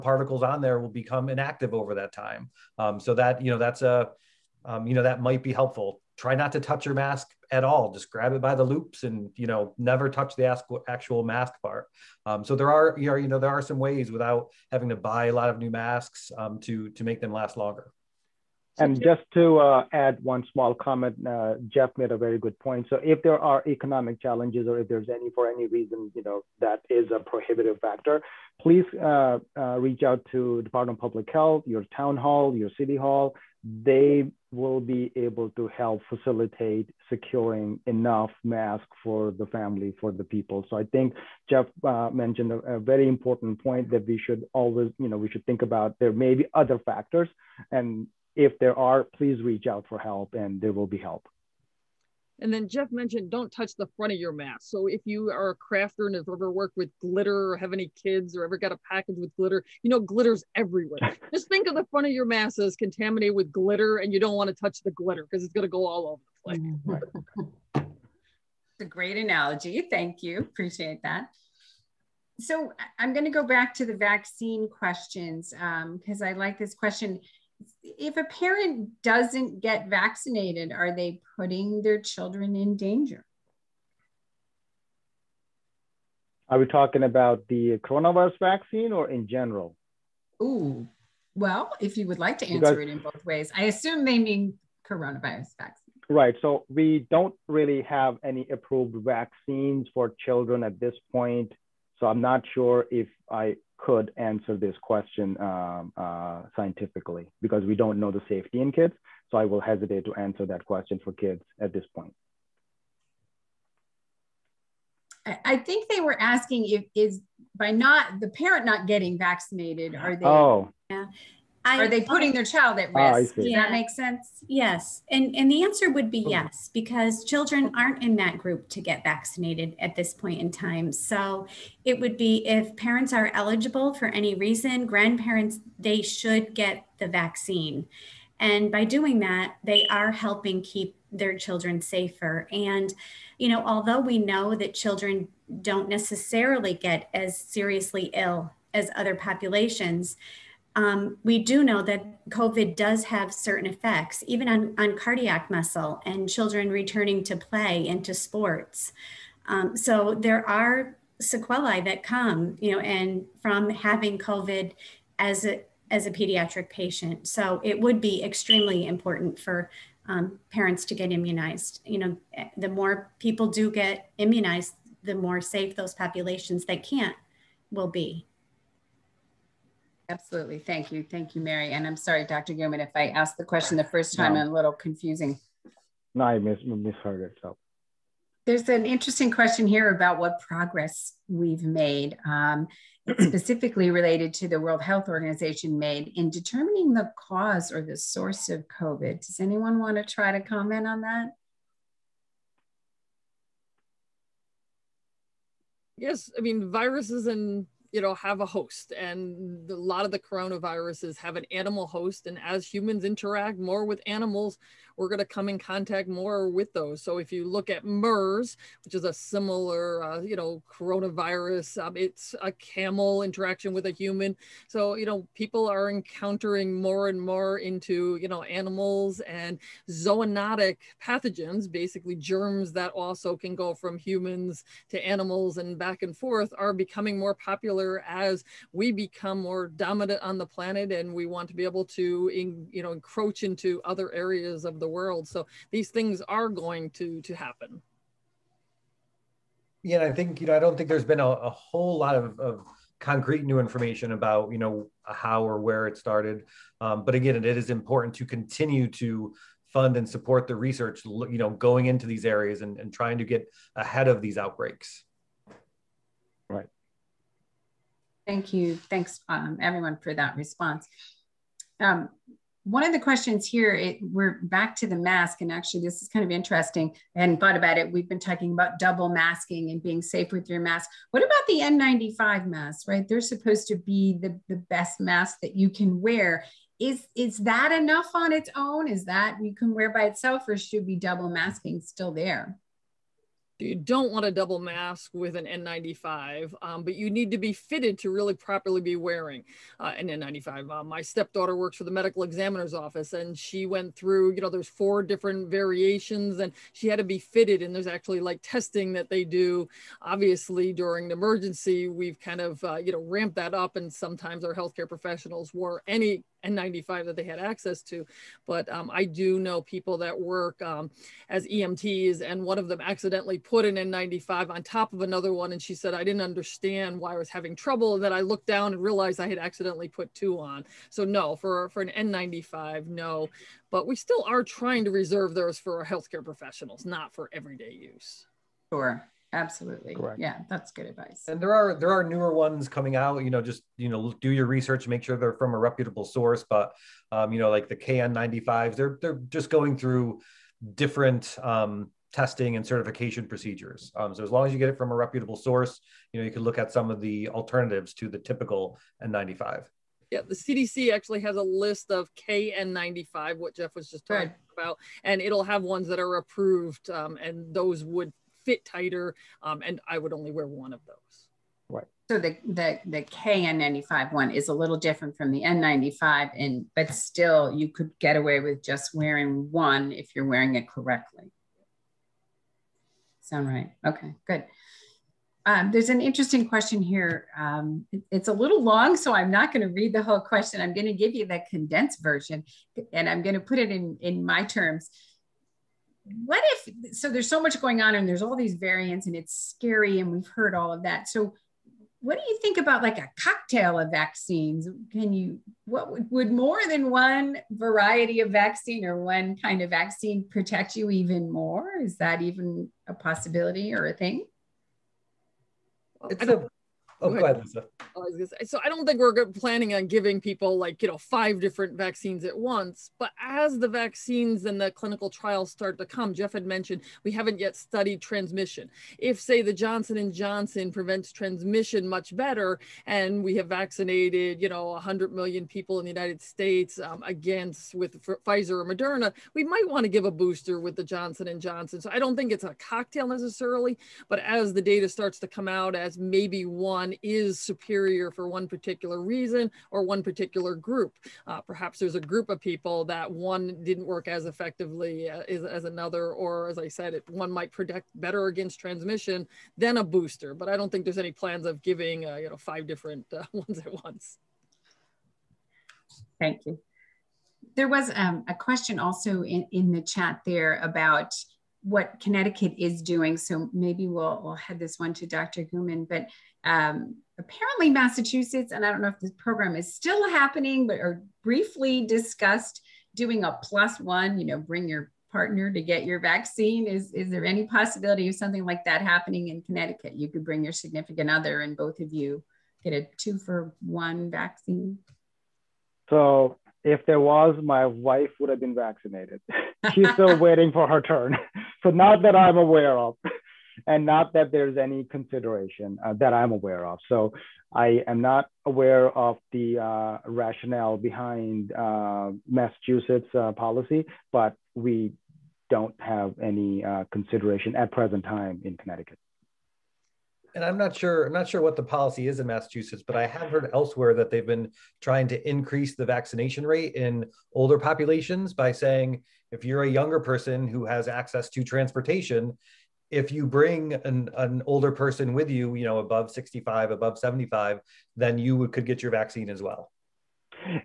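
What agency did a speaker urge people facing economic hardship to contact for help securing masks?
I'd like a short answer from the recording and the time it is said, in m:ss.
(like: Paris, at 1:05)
Department of Public Health, at 0:30.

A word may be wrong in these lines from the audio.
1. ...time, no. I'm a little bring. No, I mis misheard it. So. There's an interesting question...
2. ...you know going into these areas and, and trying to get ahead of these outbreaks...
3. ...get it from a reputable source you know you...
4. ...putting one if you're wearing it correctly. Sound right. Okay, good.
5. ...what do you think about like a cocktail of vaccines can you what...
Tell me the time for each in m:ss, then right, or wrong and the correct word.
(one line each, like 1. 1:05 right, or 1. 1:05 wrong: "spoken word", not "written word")
1. 3:04 wrong: "confusing", not "bring"
2. 4:21 right
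3. 5:54 right
4. 6:18 wrong: "wearing", not "putting"
5. 6:42 right.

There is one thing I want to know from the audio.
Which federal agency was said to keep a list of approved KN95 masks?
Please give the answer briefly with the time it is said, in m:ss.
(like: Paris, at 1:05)
CDC, at 6:00.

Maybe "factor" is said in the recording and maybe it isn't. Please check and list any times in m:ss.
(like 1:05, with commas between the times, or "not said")
0:27, 0:46.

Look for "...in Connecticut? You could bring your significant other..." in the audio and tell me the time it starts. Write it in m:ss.
8:09.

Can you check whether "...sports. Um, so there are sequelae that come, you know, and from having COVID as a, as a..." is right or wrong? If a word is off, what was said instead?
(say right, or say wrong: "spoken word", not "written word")
right.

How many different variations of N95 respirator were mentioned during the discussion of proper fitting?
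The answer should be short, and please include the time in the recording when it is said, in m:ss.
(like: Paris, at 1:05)
4, at 5:04.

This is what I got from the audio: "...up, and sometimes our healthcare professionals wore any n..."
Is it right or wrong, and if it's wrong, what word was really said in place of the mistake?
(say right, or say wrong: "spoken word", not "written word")
right.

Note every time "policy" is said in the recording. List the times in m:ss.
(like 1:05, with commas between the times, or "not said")
8:33, 8:41.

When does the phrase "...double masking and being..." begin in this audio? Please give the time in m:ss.
4:38.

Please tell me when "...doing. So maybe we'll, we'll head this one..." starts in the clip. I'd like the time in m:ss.
7:52.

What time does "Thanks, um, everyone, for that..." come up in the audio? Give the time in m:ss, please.
4:28.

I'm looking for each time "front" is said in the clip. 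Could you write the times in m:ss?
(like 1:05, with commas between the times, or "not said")
0:53, 1:01.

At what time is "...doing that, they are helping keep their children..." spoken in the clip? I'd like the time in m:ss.
2:18.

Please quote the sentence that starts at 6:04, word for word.
about, and it'll have ones that are approved, um, and those would fit tighter.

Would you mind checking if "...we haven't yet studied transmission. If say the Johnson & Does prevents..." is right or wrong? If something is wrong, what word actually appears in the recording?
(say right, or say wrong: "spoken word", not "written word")
wrong: "Johnson", not "Does".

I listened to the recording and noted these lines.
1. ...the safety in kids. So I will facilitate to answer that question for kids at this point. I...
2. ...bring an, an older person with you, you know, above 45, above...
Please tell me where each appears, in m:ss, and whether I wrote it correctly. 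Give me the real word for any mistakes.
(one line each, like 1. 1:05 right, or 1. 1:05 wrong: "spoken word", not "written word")
1. 1:48 wrong: "hesitate", not "facilitate"
2. 8:53 wrong: "65", not "45".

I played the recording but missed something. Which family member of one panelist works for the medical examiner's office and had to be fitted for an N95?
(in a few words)
Stepdaughter.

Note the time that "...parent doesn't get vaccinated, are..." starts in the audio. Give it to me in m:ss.
1:18.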